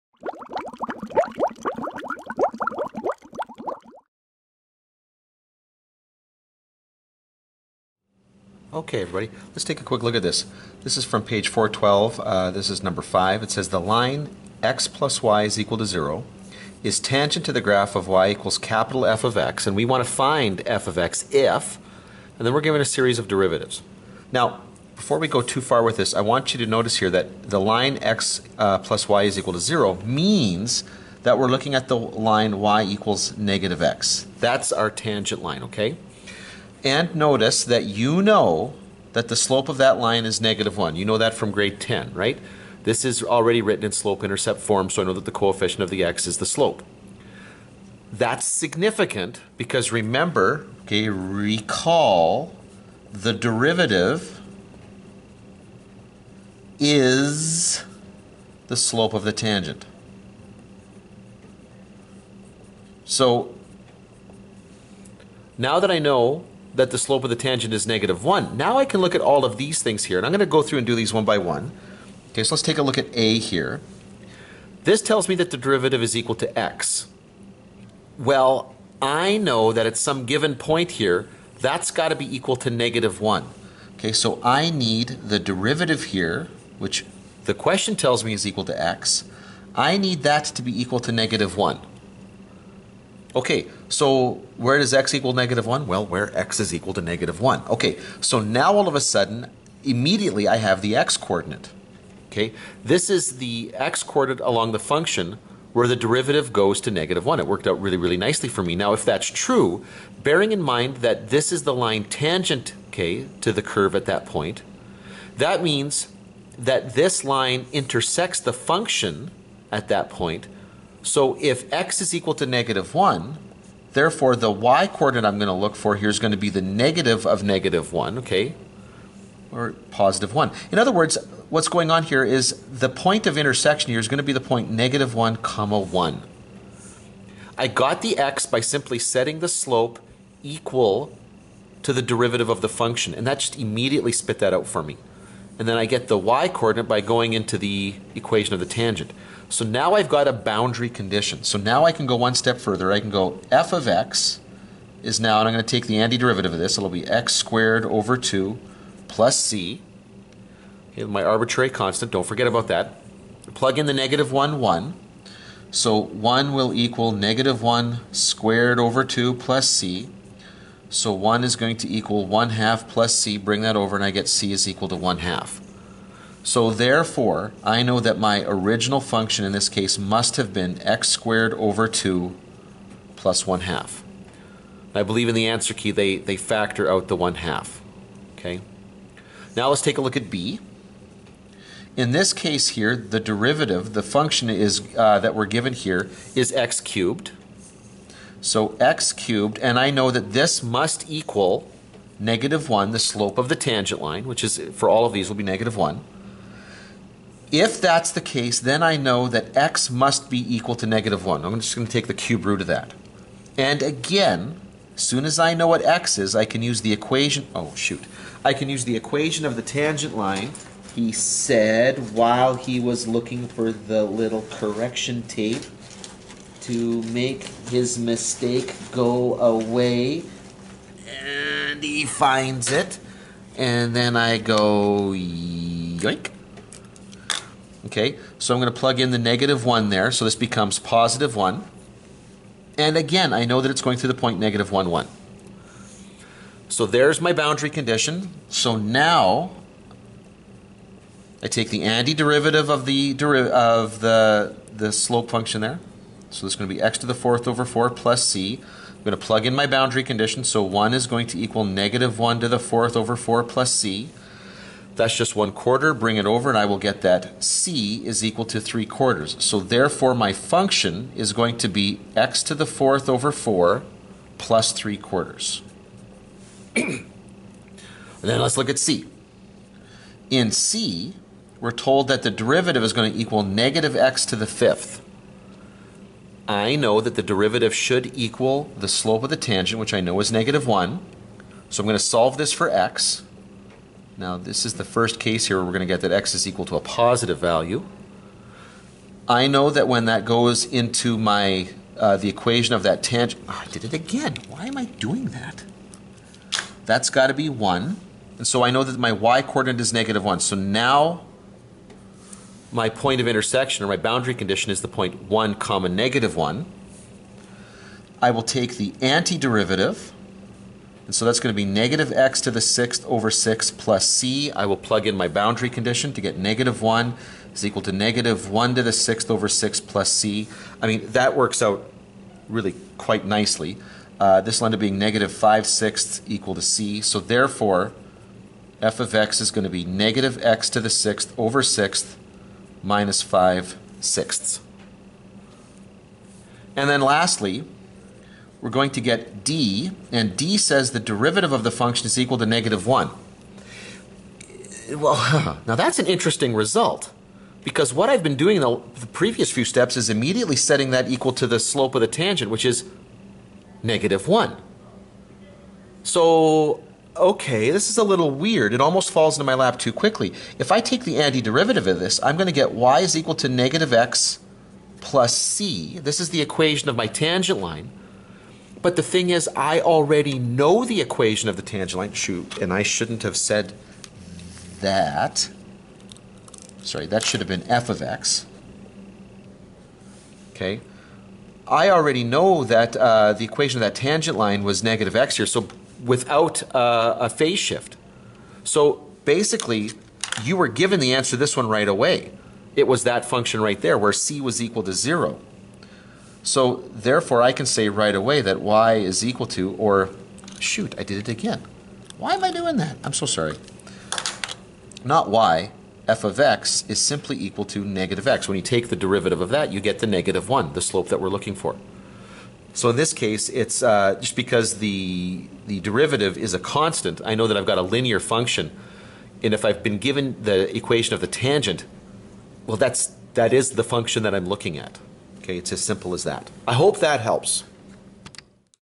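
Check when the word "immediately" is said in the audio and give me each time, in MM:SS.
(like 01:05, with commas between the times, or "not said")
01:39, 02:23, 06:00.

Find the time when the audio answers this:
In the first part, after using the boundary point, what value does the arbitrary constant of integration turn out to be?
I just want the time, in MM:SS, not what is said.
02:54.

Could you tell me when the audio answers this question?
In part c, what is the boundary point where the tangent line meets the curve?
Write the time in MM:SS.
05:15.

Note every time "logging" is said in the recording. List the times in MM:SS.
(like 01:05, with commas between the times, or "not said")
not said.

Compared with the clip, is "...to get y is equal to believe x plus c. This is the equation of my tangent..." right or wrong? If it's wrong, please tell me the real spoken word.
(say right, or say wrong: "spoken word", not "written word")
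wrong: "negative", not "believe".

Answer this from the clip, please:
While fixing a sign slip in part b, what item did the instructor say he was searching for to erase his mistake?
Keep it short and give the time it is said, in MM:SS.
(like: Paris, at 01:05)
correction tape, at 03:44.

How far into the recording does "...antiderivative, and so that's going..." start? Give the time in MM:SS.
05:18.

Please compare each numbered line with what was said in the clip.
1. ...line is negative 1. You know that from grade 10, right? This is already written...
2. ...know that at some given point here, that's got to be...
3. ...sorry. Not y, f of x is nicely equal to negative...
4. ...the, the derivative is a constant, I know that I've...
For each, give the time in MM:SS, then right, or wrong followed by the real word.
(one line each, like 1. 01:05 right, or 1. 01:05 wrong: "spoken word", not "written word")
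1. 00:39 right
2. 01:19 right
3. 06:53 wrong: "simply", not "nicely"
4. 07:04 right.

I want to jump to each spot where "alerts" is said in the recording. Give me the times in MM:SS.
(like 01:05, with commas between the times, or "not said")
not said.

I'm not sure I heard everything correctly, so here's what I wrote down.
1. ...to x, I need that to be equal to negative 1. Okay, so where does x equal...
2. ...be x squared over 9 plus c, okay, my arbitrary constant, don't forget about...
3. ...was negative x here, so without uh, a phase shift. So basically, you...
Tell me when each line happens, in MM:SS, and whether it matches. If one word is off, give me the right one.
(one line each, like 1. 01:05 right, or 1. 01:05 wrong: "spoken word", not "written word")
1. 01:28 right
2. 02:36 wrong: "2", not "9"
3. 06:34 right.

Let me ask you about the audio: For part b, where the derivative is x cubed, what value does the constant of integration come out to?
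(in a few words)
3/4.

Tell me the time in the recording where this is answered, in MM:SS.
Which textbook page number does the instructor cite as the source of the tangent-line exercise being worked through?
00:11.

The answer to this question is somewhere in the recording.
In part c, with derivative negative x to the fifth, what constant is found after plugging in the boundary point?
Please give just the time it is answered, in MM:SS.
05:34.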